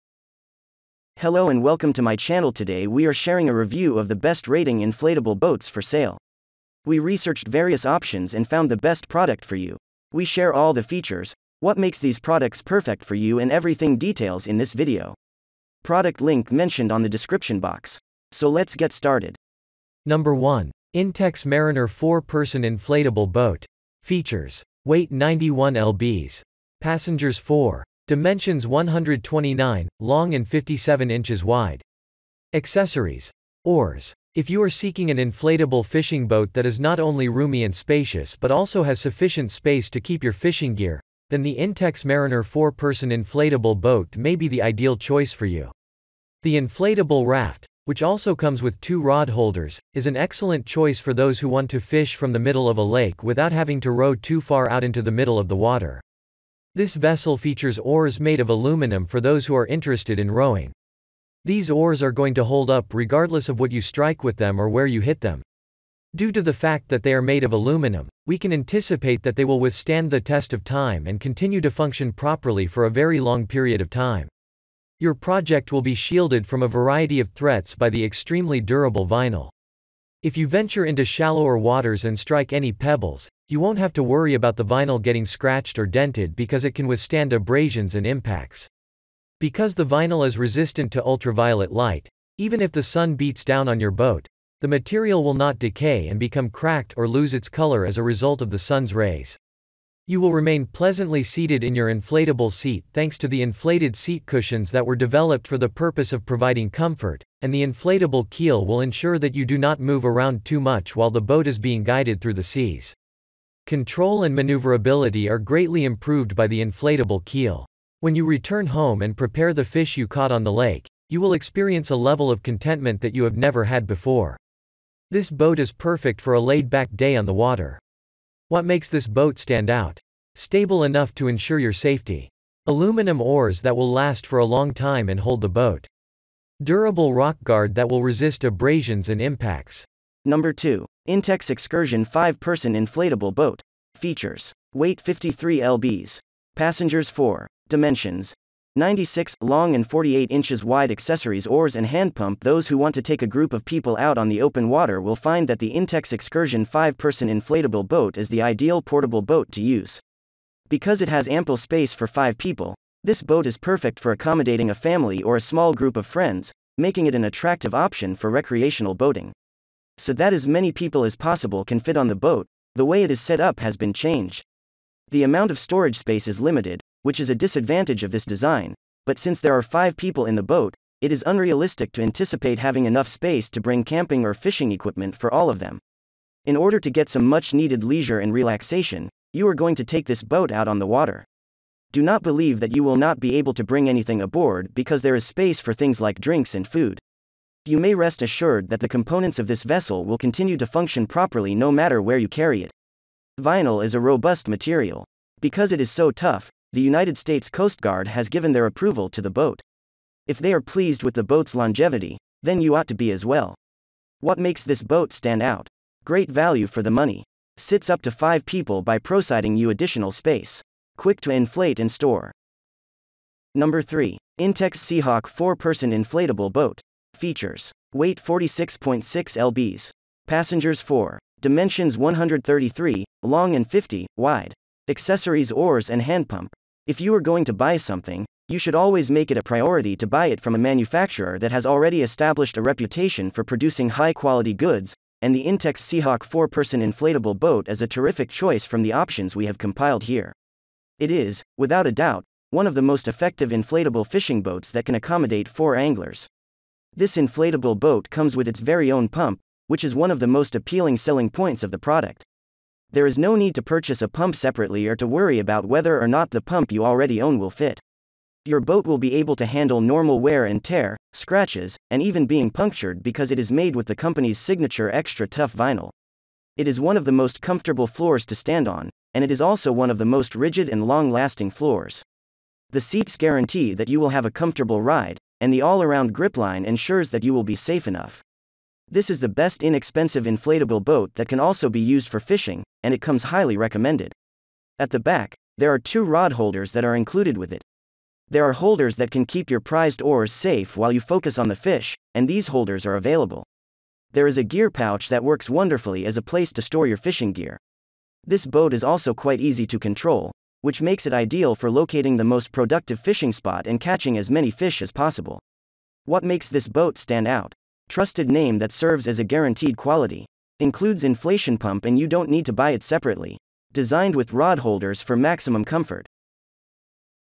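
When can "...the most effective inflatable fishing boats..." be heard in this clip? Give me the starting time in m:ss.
4:12.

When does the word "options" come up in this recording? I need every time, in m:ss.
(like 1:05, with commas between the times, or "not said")
0:07, 2:47, 4:08.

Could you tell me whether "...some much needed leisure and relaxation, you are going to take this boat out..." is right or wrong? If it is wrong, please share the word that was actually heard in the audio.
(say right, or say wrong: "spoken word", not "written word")
right.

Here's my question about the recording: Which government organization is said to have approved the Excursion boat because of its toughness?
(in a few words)
United States Coast Guard.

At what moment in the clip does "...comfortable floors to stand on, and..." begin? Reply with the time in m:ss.
4:37.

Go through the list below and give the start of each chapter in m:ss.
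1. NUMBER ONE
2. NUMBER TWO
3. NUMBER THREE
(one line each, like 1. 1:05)
1. 0:20
2. 2:19
3. 3:42.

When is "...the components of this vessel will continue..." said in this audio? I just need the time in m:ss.
3:18.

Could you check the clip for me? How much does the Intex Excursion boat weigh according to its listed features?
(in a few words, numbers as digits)
53 lbs.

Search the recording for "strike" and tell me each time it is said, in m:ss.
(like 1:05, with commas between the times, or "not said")
1:03, 1:22.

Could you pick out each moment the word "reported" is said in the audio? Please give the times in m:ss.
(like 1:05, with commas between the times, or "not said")
not said.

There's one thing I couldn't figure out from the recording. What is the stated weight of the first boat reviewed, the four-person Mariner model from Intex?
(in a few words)
91 lbs.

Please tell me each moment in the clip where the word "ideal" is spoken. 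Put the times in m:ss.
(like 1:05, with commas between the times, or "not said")
0:44, 2:38, 5:11.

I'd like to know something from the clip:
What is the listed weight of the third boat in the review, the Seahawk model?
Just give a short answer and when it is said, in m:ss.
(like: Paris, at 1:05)
46.6 lbs, at 3:48.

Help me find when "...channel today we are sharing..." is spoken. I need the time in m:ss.
0:02.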